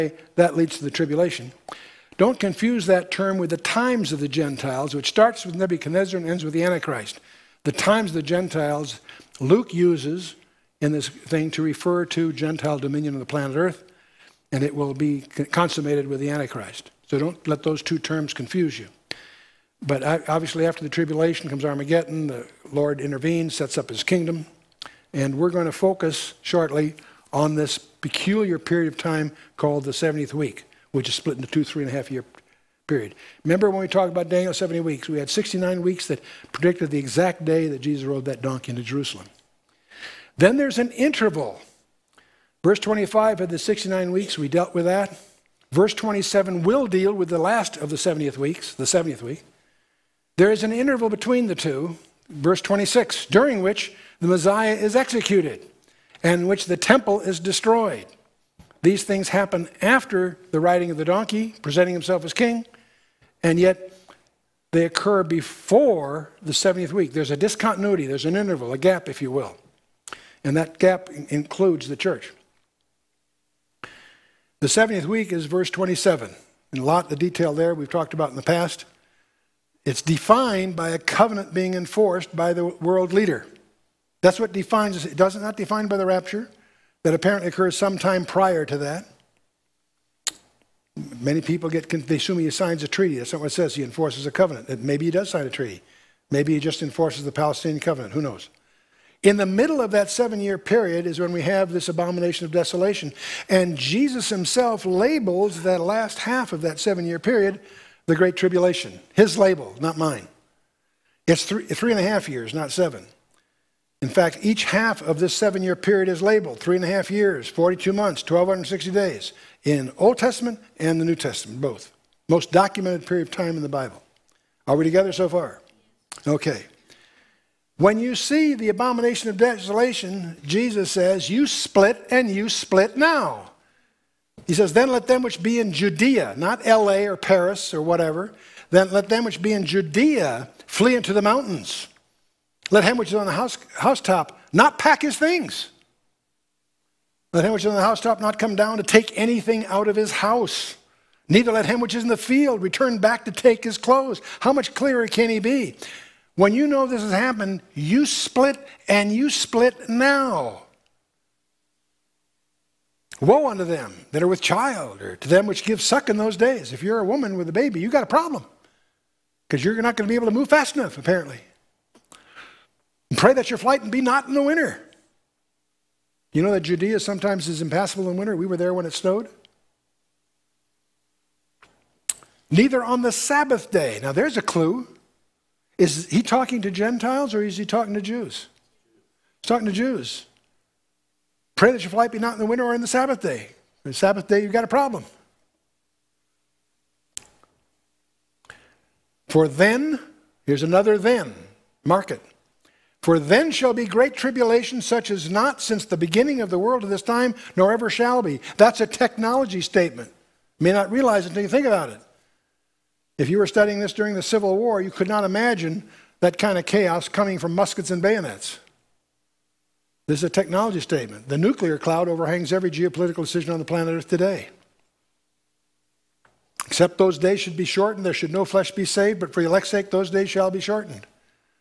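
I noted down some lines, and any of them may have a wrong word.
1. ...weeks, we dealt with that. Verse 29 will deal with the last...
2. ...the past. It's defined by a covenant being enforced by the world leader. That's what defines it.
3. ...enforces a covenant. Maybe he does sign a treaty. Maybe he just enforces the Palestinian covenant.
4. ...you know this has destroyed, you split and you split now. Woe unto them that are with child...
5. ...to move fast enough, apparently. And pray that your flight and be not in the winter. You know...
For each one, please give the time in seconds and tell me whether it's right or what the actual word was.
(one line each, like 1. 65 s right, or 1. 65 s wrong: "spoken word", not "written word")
1. 44 s wrong: "27", not "29"
2. 78 s right
3. 93 s right
4. 156 s wrong: "happened", not "destroyed"
5. 170 s right.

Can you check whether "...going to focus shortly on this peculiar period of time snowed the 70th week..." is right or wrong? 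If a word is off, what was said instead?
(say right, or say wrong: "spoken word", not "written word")
wrong: "called", not "snowed".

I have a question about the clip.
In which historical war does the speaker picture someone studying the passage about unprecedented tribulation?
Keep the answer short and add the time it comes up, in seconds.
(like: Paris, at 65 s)
Civil War, at 214 s.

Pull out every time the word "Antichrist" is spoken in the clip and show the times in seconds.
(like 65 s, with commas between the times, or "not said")
6 s, 16 s.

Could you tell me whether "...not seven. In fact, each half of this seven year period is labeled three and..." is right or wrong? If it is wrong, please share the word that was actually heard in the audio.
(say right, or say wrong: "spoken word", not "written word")
right.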